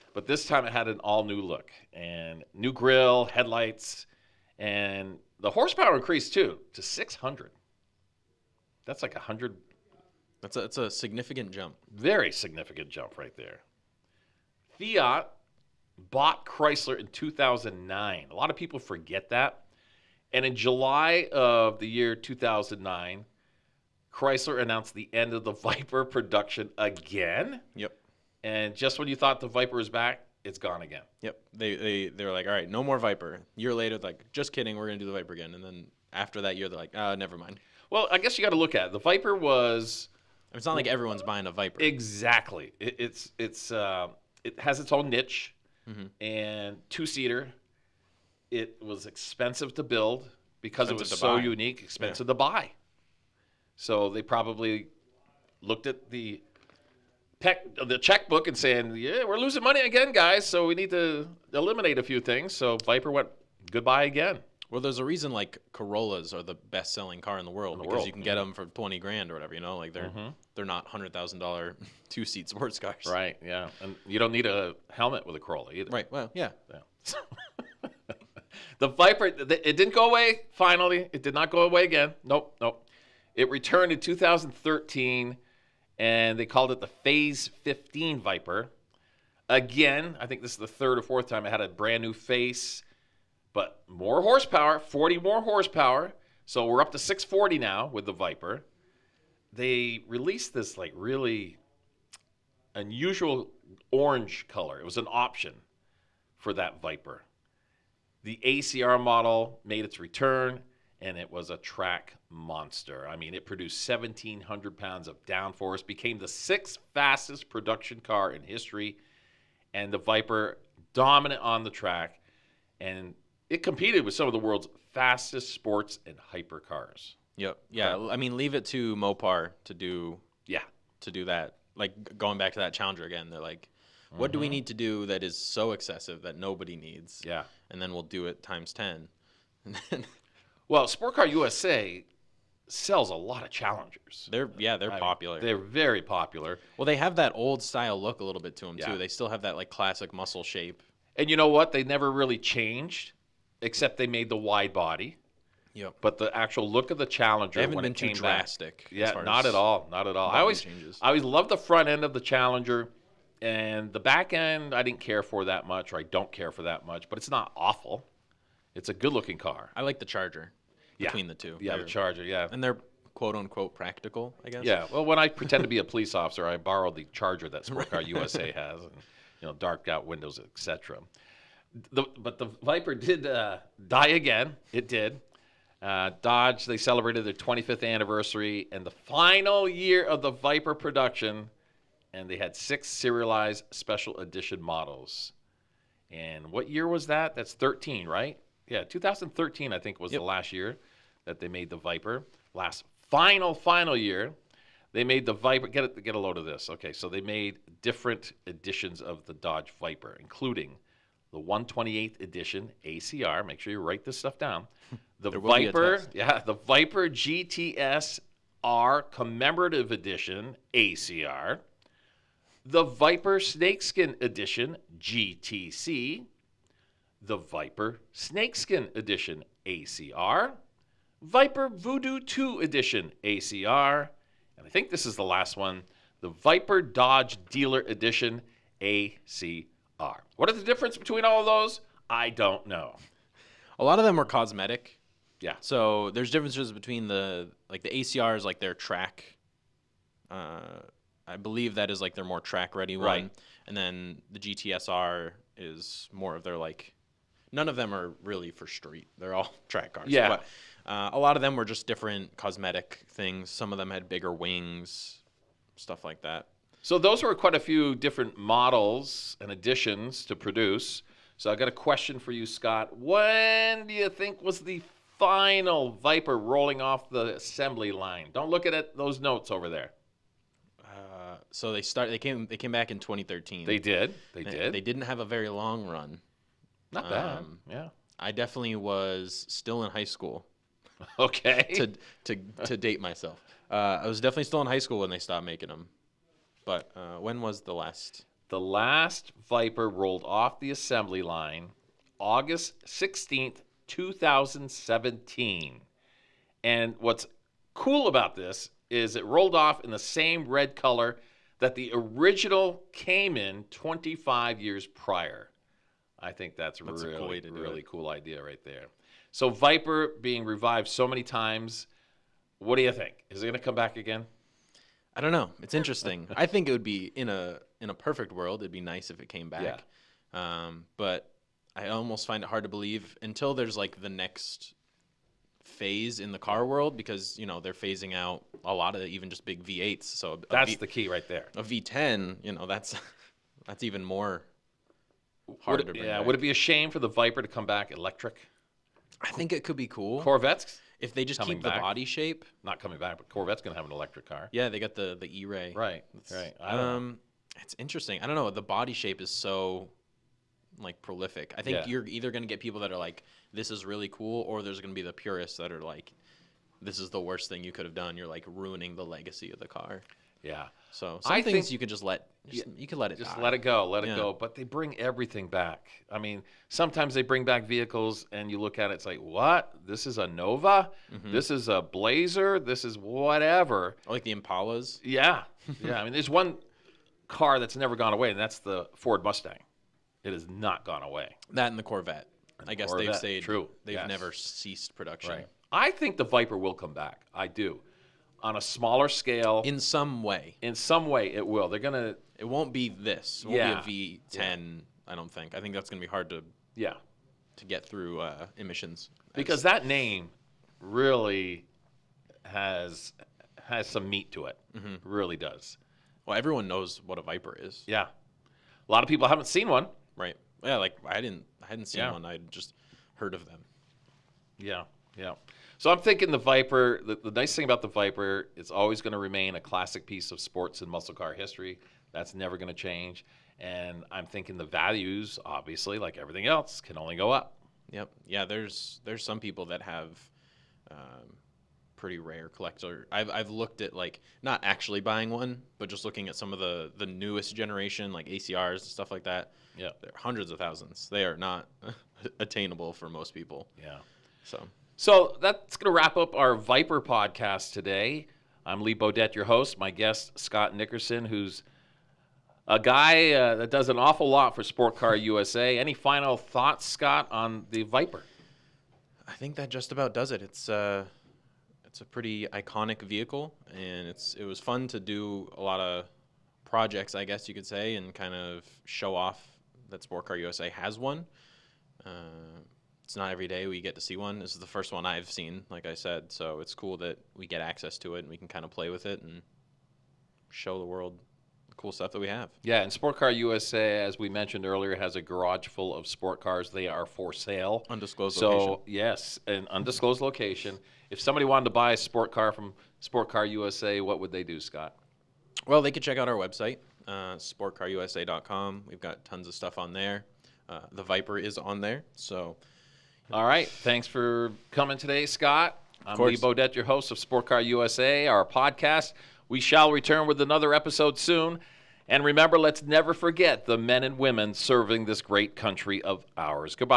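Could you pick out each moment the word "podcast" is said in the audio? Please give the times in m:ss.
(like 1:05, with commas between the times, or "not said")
7:37, 8:38.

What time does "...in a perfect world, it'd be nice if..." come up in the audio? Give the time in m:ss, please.
5:27.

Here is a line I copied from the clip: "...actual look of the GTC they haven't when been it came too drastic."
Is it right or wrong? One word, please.
wrong.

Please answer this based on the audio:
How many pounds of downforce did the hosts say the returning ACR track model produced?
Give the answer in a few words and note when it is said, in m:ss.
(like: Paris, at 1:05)
1,700 pounds, at 1:53.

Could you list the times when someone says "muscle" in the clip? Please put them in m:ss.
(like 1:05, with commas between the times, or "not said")
2:30, 7:10.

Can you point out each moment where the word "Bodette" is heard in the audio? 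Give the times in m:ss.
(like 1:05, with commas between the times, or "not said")
7:38, 8:36.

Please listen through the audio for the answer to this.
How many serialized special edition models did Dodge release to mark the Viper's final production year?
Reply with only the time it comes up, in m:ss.
3:12.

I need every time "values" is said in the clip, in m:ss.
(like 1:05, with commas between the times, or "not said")
7:14.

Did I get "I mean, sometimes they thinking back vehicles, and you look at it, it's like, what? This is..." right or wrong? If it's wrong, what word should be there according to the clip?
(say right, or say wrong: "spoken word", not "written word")
wrong: "bring", not "thinking".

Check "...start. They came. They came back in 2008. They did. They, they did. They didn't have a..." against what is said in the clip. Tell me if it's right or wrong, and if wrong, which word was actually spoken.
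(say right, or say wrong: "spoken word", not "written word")
wrong: "2013", not "2008".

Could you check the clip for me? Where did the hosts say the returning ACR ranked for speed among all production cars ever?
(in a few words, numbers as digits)
sixth fastest.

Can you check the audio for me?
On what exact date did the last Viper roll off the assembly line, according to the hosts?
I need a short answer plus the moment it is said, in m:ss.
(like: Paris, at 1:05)
August 16, 2017, at 5:02.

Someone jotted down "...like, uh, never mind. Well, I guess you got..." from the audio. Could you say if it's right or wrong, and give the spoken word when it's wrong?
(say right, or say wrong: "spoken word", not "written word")
right.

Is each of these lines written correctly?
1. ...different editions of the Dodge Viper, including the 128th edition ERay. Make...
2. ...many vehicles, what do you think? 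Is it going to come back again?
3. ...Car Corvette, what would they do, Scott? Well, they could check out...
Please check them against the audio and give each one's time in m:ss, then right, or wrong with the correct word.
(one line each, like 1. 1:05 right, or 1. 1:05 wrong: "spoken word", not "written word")
1. 3:27 wrong: "ACR", not "ERay"
2. 5:21 wrong: "times", not "vehicles"
3. 8:23 wrong: "USA", not "Corvette".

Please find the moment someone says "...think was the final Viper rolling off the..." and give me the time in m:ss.
4:34.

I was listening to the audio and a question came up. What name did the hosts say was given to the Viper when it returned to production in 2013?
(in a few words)
Phase 15 Viper.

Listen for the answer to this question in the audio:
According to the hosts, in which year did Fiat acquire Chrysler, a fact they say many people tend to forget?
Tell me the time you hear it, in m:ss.
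0:14.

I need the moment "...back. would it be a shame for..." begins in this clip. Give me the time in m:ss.
5:46.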